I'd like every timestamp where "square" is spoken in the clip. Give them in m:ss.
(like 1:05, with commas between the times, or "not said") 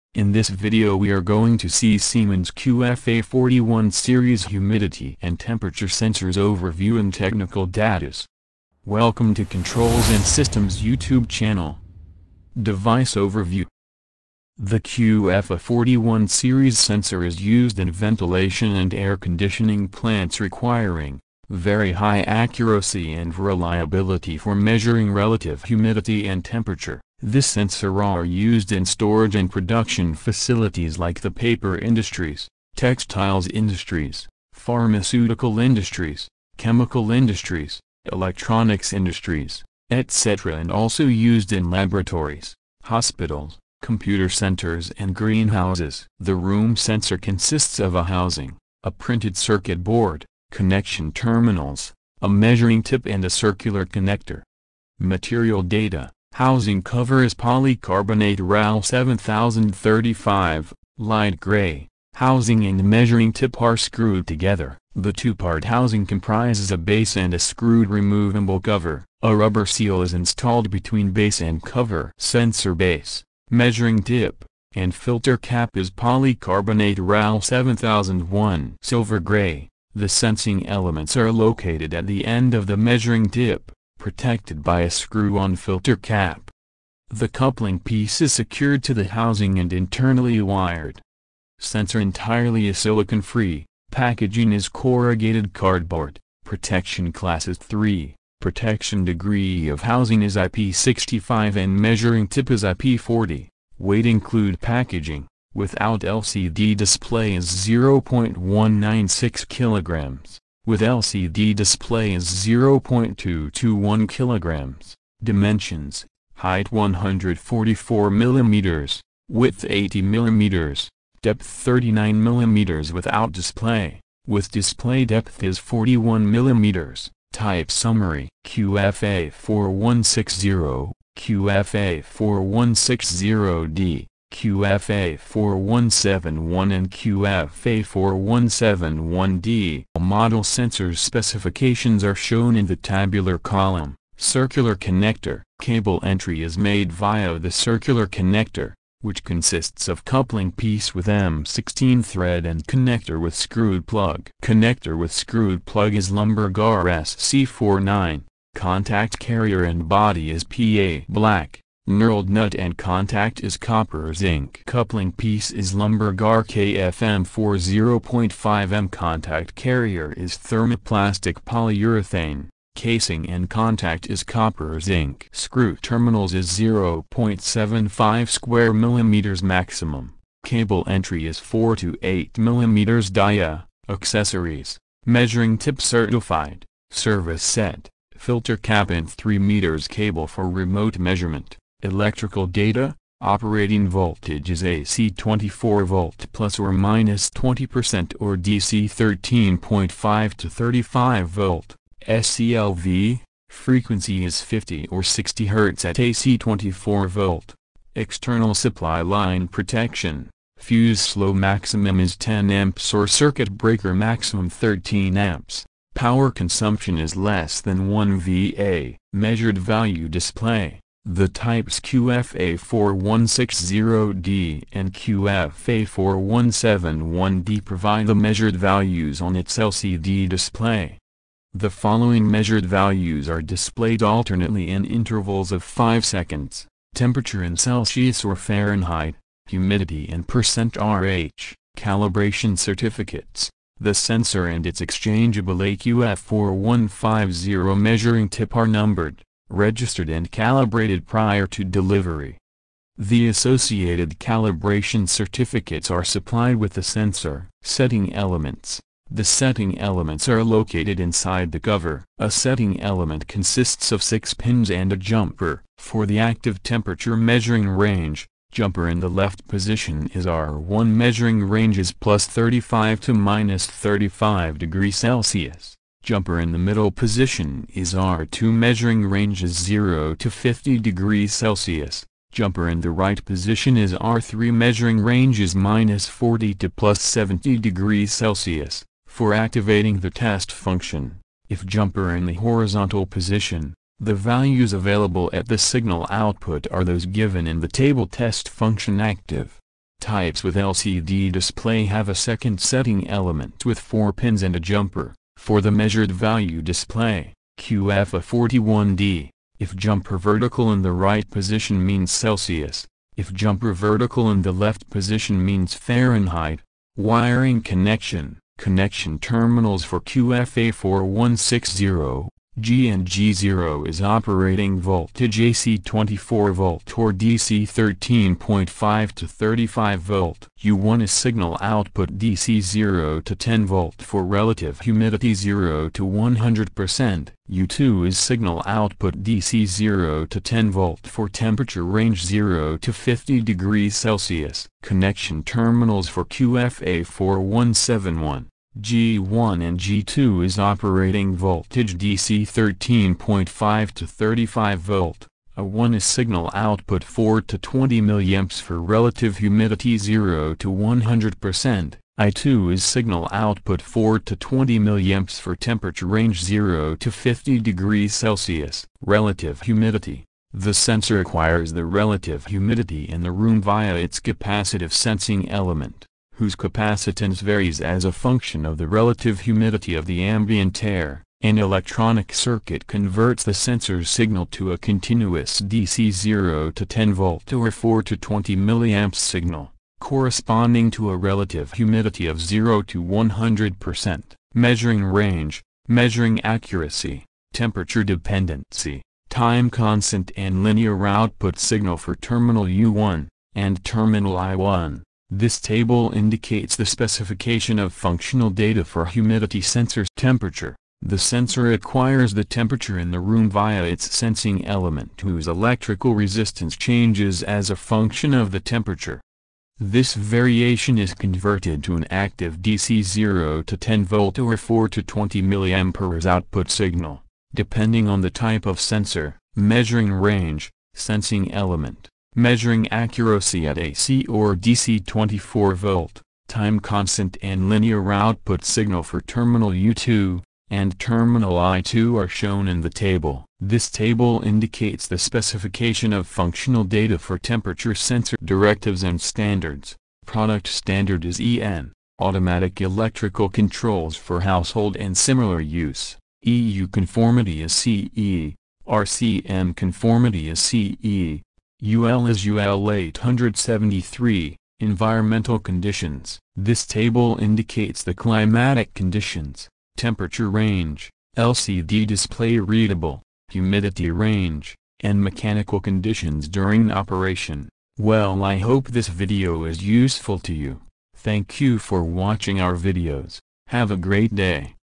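2:58.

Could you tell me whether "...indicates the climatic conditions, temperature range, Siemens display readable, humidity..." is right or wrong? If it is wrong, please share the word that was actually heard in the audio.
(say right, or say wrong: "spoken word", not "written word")
wrong: "LCD", not "Siemens".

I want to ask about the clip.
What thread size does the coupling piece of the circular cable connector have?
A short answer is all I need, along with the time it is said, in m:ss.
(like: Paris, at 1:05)
M16, at 2:31.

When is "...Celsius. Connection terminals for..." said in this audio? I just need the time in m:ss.
5:43.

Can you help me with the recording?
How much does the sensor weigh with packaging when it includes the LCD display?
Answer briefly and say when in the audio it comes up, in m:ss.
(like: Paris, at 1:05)
0.221 kilograms, at 1:52.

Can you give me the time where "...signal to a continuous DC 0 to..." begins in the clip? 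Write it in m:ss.
6:24.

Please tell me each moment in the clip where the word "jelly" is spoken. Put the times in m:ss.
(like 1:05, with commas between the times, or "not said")
not said.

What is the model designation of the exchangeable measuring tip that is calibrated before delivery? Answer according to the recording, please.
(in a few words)
AQF4150.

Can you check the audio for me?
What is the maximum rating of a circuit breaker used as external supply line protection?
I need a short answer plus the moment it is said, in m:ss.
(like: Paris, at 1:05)
13 amps, at 3:34.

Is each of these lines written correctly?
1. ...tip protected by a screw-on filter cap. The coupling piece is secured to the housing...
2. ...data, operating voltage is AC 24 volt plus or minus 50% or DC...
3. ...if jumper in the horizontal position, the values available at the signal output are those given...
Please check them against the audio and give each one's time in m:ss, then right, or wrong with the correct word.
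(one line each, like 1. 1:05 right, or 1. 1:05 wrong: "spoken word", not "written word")
1. 1:23 right
2. 3:12 wrong: "20", not "50"
3. 4:51 right.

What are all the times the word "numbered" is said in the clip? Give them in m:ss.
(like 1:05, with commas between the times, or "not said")
4:08.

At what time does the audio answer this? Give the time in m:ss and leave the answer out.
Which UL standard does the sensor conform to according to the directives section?
7:42.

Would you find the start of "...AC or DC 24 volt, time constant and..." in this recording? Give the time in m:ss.
7:13.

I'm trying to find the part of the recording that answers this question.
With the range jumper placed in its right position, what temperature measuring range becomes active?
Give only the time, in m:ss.
4:45.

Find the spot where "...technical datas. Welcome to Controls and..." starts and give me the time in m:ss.
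0:07.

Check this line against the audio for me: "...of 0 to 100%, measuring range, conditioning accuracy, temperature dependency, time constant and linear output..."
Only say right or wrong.
wrong.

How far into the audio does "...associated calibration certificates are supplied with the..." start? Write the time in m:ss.
4:13.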